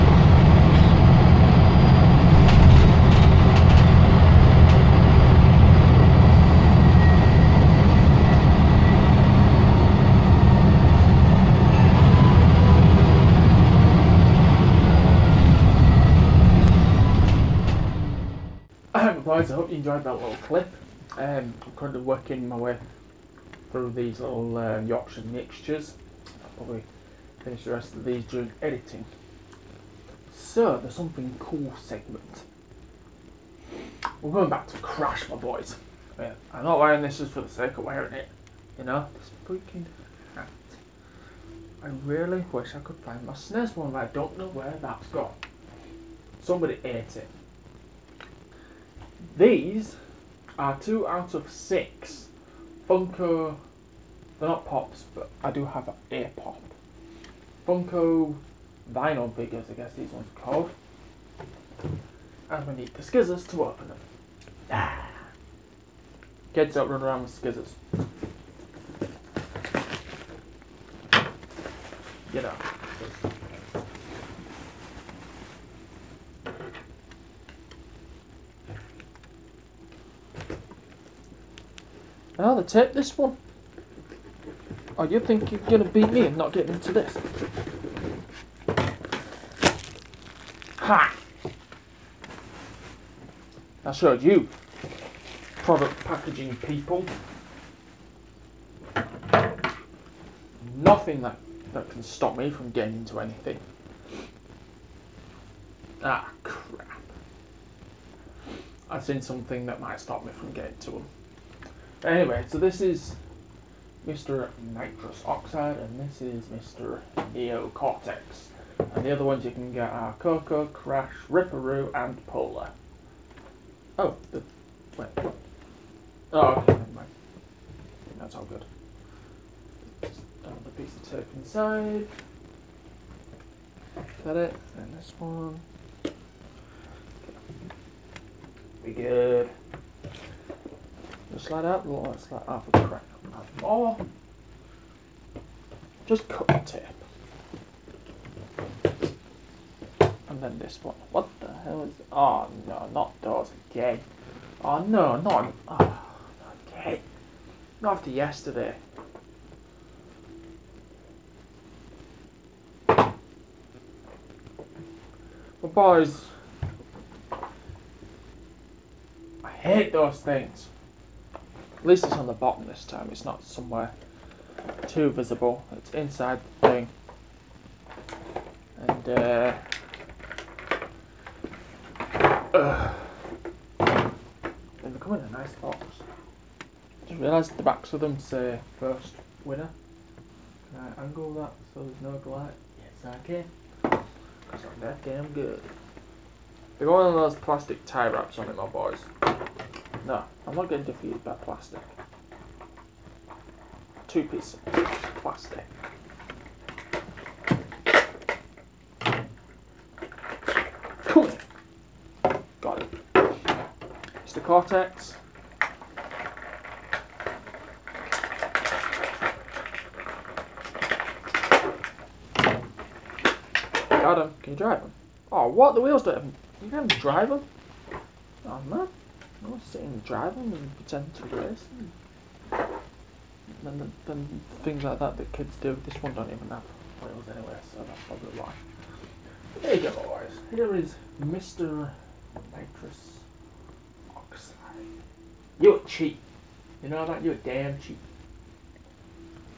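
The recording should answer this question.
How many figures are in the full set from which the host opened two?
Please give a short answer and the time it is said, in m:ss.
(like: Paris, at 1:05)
6, at 0:51.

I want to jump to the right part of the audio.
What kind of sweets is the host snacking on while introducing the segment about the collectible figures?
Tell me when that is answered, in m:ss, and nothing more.
0:24.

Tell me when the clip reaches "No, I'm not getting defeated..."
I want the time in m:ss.
3:20.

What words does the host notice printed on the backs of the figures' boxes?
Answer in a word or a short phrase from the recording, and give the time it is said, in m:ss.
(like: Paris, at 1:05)
first winner, at 3:08.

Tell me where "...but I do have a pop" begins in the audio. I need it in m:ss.
0:55.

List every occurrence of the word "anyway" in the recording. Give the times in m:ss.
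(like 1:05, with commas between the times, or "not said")
1:52, 3:57.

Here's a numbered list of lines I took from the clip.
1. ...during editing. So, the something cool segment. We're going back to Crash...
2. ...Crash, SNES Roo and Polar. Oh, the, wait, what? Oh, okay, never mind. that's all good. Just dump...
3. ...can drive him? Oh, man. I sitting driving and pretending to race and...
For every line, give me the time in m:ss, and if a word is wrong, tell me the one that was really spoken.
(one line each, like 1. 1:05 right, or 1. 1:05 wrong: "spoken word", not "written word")
1. 0:28 right
2. 2:00 wrong: "Ripper", not "SNES"
3. 3:46 right.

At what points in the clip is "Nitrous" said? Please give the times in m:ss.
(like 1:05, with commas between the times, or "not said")
1:54, 4:02.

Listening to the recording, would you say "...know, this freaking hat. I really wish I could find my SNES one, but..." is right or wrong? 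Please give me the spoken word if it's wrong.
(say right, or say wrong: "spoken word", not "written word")
right.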